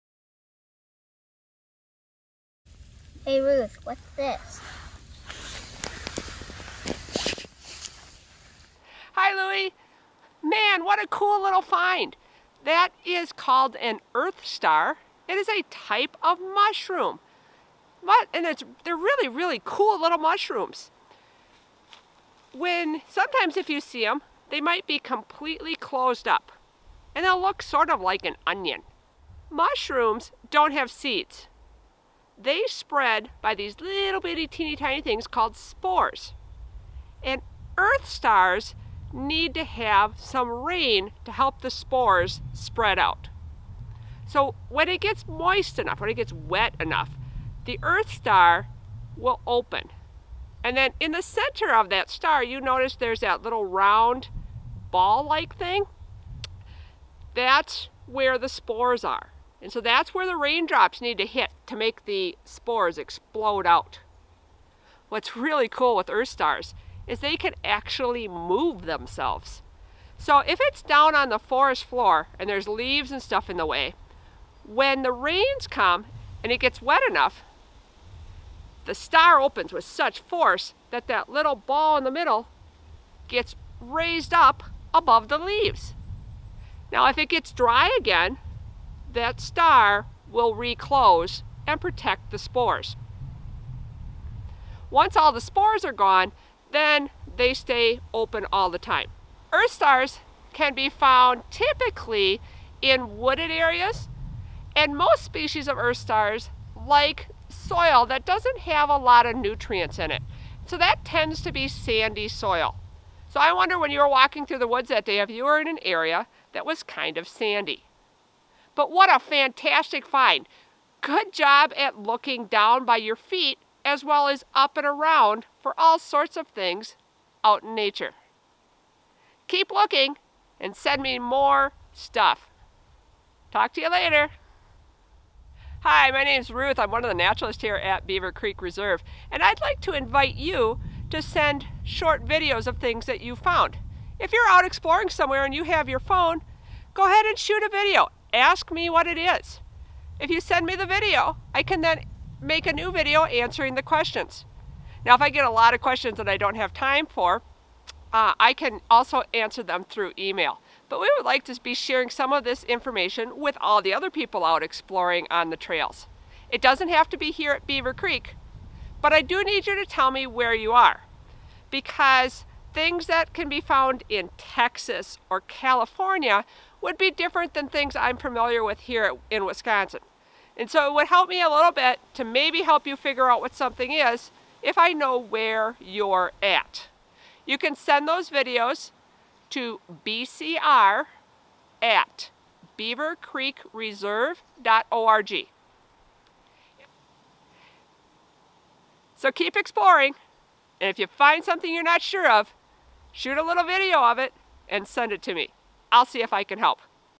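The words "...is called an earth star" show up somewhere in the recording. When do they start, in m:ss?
0:13.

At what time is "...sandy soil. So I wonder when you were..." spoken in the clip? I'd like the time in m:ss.
1:51.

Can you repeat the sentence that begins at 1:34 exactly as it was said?
Once all the spores are gone, then they stay open all the time.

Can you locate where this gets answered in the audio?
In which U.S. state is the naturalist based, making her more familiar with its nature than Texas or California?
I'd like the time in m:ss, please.
2:59.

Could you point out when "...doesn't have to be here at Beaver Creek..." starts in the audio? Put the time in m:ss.
2:46.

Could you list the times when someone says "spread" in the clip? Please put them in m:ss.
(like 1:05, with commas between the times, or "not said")
0:32, 0:42.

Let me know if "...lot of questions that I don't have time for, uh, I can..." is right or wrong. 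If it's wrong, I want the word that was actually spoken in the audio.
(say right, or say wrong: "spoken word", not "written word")
right.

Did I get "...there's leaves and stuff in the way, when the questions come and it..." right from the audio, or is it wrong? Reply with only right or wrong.
wrong.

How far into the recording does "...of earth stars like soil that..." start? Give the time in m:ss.
1:45.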